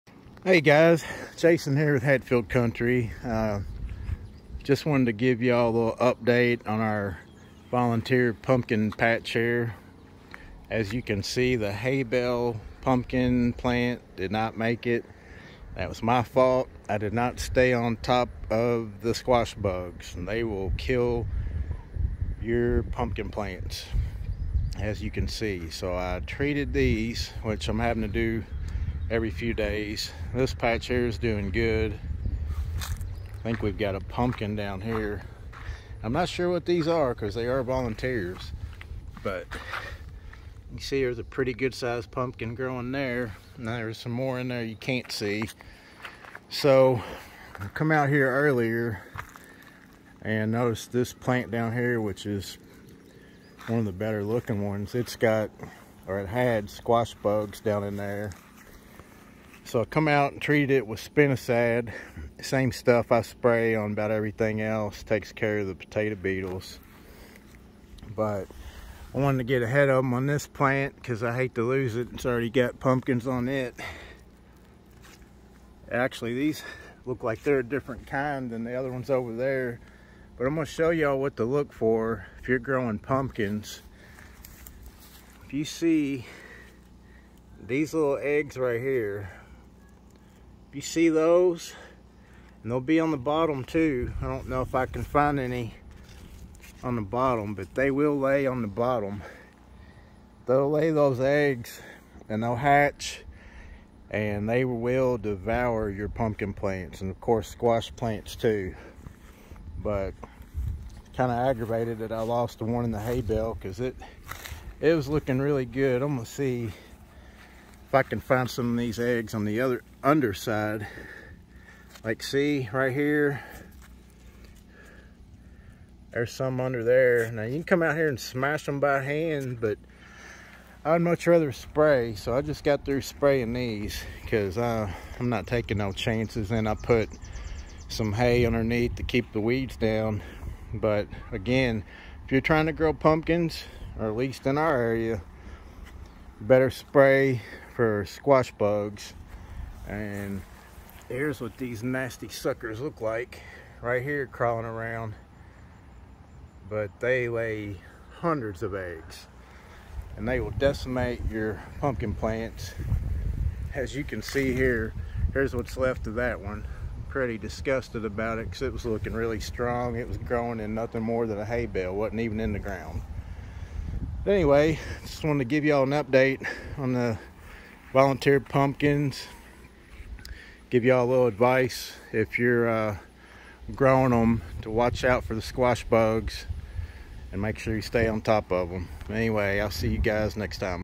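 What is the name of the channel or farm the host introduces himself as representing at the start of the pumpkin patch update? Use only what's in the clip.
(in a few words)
Hatfield Country.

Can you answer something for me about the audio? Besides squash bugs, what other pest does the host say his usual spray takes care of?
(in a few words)
potato beetles.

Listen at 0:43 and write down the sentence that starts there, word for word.
Now there's some more in there you can't see.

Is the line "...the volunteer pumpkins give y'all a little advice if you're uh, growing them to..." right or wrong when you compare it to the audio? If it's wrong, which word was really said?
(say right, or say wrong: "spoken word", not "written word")
right.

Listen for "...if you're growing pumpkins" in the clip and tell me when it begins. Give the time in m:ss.
1:22.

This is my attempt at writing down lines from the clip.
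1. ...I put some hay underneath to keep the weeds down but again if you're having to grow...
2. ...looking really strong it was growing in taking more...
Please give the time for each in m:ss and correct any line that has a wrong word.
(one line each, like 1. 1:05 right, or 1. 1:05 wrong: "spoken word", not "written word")
1. 2:16 wrong: "trying", not "having"
2. 2:48 wrong: "nothing", not "taking".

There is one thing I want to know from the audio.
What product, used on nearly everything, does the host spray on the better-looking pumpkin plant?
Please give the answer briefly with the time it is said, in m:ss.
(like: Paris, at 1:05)
spinosad, at 1:00.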